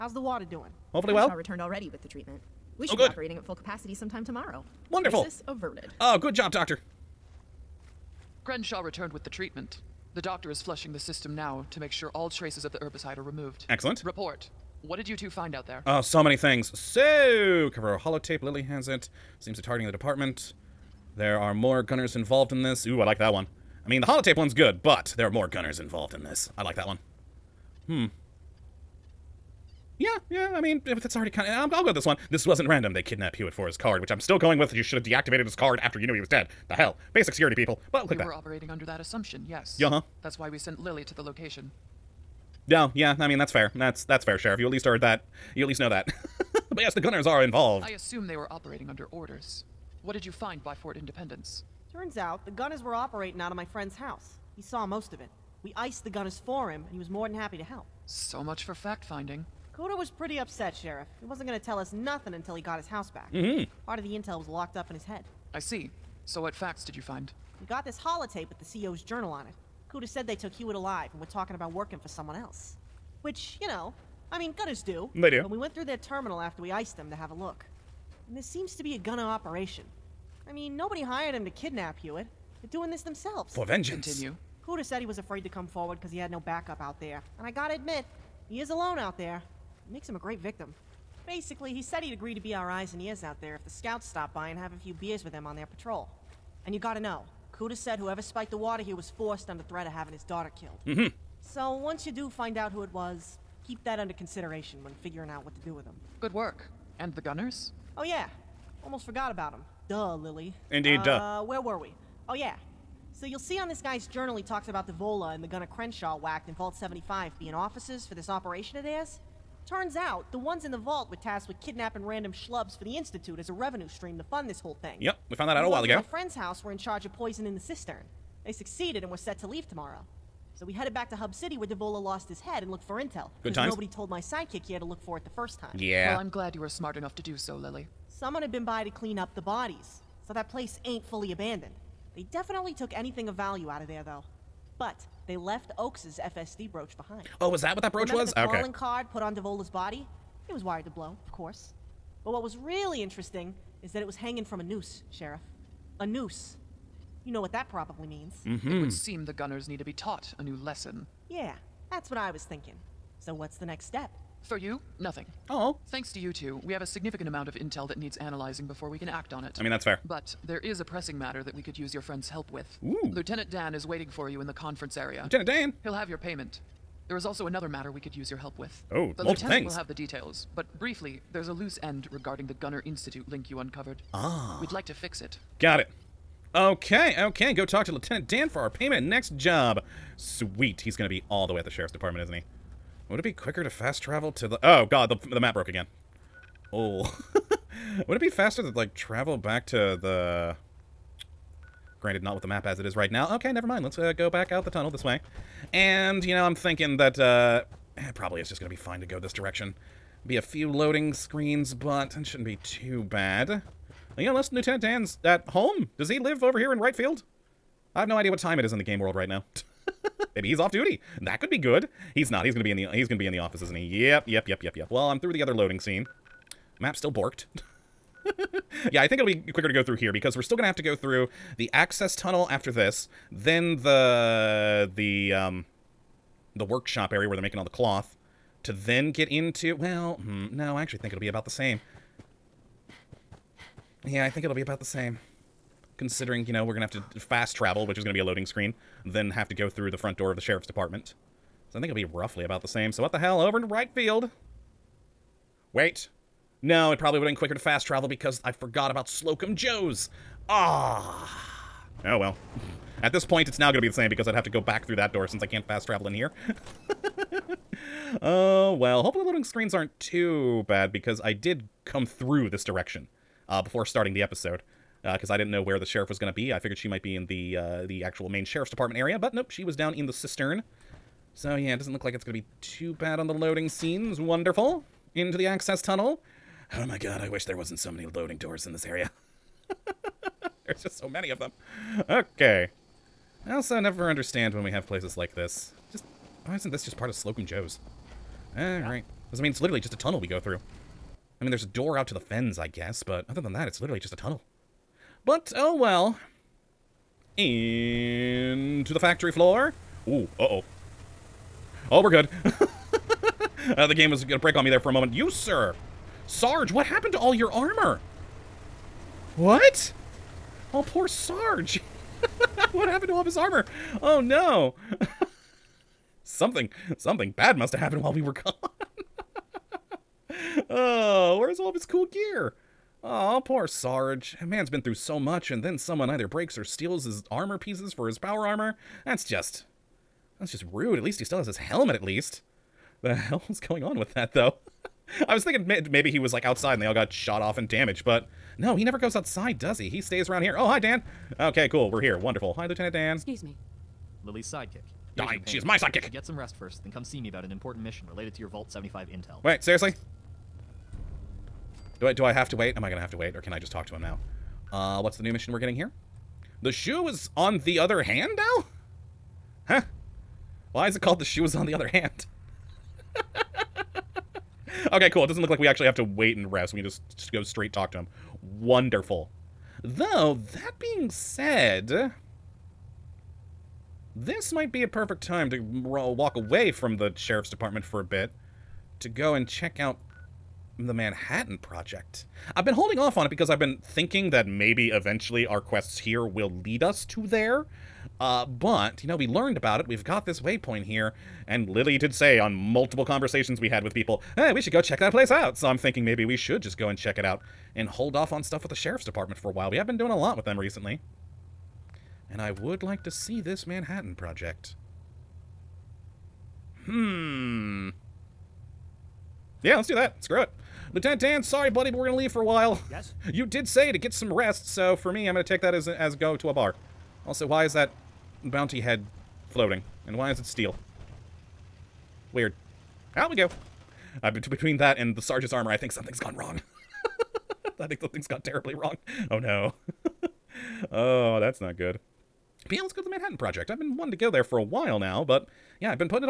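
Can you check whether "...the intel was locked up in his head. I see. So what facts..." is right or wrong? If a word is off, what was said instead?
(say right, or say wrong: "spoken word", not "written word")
right.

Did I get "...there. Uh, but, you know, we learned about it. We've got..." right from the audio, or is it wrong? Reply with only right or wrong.
right.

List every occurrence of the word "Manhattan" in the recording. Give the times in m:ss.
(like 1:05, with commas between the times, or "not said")
6:30, 6:53, 7:23.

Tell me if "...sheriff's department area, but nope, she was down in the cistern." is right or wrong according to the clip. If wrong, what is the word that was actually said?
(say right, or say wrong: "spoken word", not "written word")
right.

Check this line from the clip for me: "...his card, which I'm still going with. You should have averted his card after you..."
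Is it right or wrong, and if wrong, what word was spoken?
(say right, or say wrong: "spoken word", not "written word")
wrong: "deactivated", not "averted".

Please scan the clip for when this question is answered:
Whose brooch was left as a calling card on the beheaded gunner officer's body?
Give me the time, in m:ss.
2:25.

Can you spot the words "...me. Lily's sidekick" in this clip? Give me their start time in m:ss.
5:53.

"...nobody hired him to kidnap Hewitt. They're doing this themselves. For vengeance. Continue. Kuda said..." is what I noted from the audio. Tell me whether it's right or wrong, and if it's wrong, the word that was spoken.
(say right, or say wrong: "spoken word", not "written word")
right.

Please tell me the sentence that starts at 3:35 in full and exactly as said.
Does he live over here in right field?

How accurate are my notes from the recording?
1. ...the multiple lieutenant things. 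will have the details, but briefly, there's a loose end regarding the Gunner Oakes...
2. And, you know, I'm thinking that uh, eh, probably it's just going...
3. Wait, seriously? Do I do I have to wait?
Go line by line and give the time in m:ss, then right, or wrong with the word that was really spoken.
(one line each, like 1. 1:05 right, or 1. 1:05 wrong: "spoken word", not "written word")
1. 2:59 wrong: "Institute", not "Oakes"
2. 3:25 right
3. 5:59 right.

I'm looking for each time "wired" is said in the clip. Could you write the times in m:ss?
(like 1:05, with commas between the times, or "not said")
2:30.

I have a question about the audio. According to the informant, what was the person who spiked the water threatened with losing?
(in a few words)
his daughter.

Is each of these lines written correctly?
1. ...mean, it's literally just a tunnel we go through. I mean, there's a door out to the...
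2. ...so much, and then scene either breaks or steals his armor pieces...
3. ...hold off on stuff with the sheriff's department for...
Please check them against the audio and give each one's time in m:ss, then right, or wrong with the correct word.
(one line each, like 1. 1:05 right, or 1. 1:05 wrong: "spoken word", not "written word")
1. 4:59 right
2. 5:34 wrong: "someone", not "scene"
3. 6:47 right.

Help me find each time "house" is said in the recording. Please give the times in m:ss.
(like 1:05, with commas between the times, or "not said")
0:53, 1:02, 2:06.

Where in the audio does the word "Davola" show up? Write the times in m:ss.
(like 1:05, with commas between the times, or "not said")
1:54, 2:11, 2:29.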